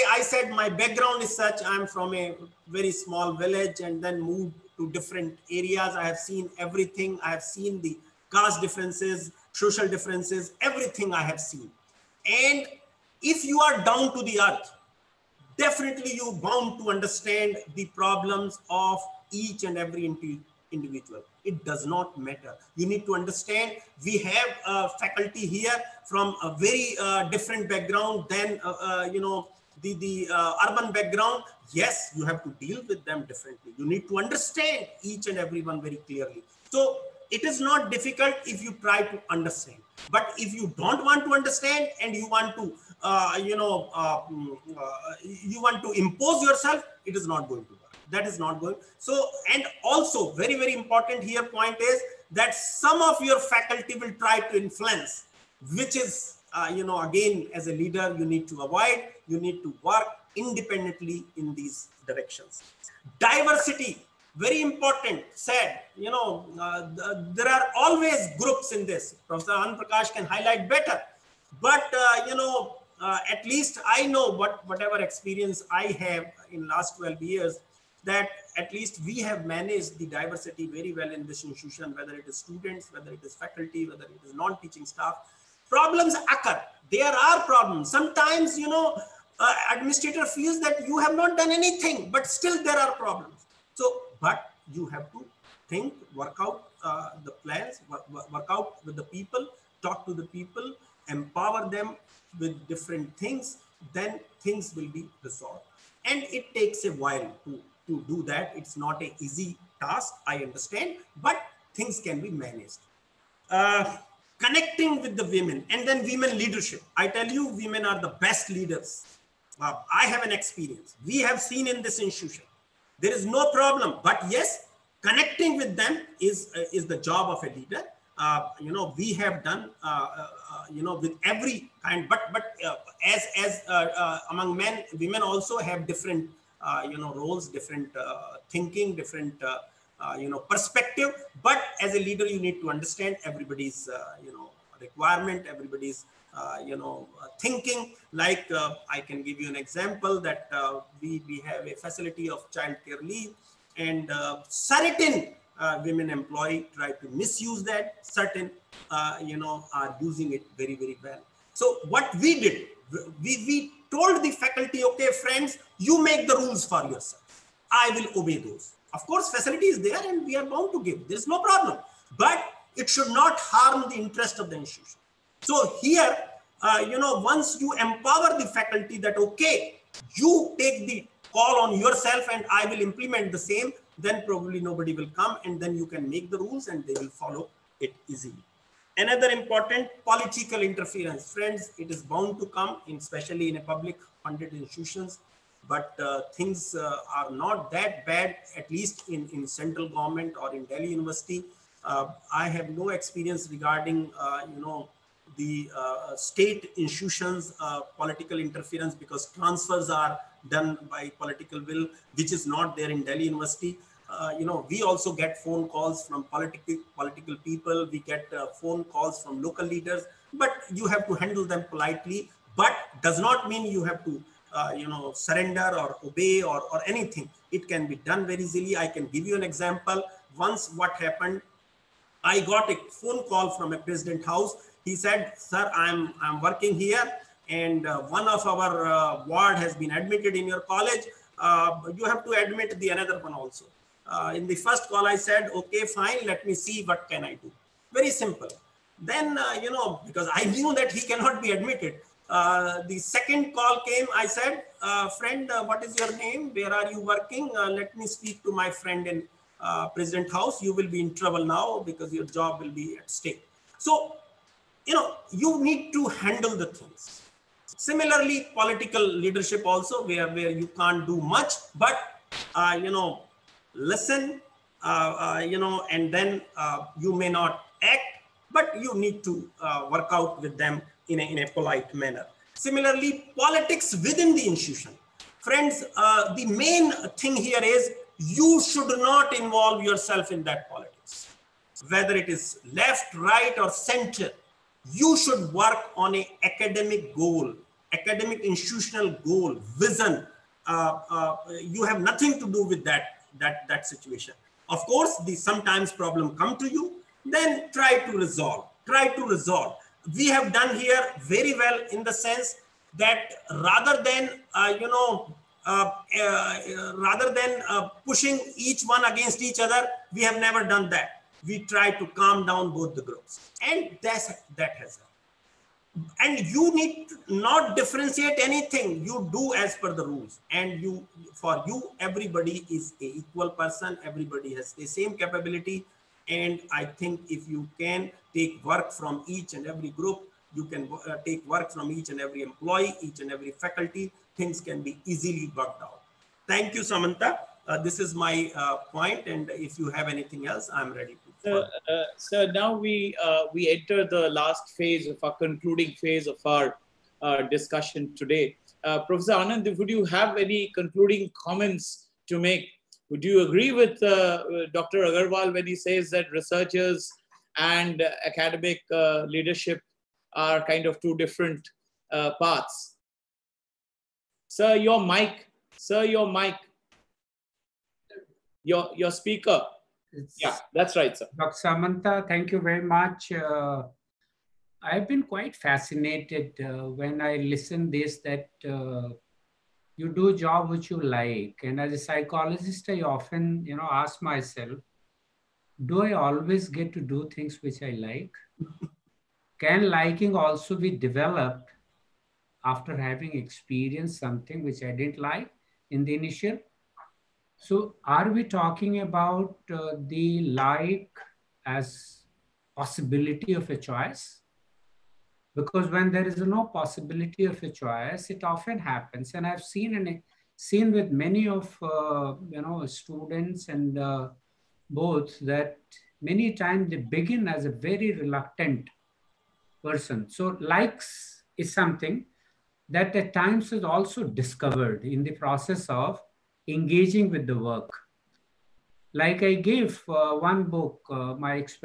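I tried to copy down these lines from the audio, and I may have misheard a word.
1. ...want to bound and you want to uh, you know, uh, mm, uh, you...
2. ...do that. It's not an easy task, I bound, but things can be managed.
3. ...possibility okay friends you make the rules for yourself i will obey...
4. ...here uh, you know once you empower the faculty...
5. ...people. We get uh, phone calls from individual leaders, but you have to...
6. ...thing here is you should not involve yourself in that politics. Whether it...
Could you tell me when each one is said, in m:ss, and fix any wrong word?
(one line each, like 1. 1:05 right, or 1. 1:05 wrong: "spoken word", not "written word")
1. 0:41 wrong: "understand", not "bound"
2. 1:48 wrong: "understand", not "bound"
3. 2:44 wrong: "faculty", not "possibility"
4. 2:55 right
5. 3:37 wrong: "local", not "individual"
6. 4:47 right.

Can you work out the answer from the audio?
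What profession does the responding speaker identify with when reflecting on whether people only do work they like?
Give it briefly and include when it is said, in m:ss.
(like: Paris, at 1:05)
psychologist, at 6:31.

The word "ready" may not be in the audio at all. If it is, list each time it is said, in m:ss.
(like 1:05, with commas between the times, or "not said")
5:51.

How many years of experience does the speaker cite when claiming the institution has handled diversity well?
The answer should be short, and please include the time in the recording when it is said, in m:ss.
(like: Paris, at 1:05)
12 years, at 1:16.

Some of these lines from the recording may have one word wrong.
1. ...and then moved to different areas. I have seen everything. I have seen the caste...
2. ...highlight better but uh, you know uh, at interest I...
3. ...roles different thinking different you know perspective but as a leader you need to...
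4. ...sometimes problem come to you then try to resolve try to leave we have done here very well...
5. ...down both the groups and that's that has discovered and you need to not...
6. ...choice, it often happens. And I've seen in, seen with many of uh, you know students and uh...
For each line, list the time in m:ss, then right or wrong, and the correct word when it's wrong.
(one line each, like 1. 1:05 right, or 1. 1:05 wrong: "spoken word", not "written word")
1. 0:03 right
2. 1:10 wrong: "least", not "interest"
3. 2:17 right
4. 5:05 wrong: "resolve", not "leave"
5. 5:22 wrong: "happened", not "discovered"
6. 6:57 right.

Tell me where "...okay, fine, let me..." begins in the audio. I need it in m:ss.
4:05.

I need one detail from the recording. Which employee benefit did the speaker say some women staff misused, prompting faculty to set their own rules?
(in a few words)
child care leave.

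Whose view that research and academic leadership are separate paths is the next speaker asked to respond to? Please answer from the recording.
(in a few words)
Dr. Agarwal.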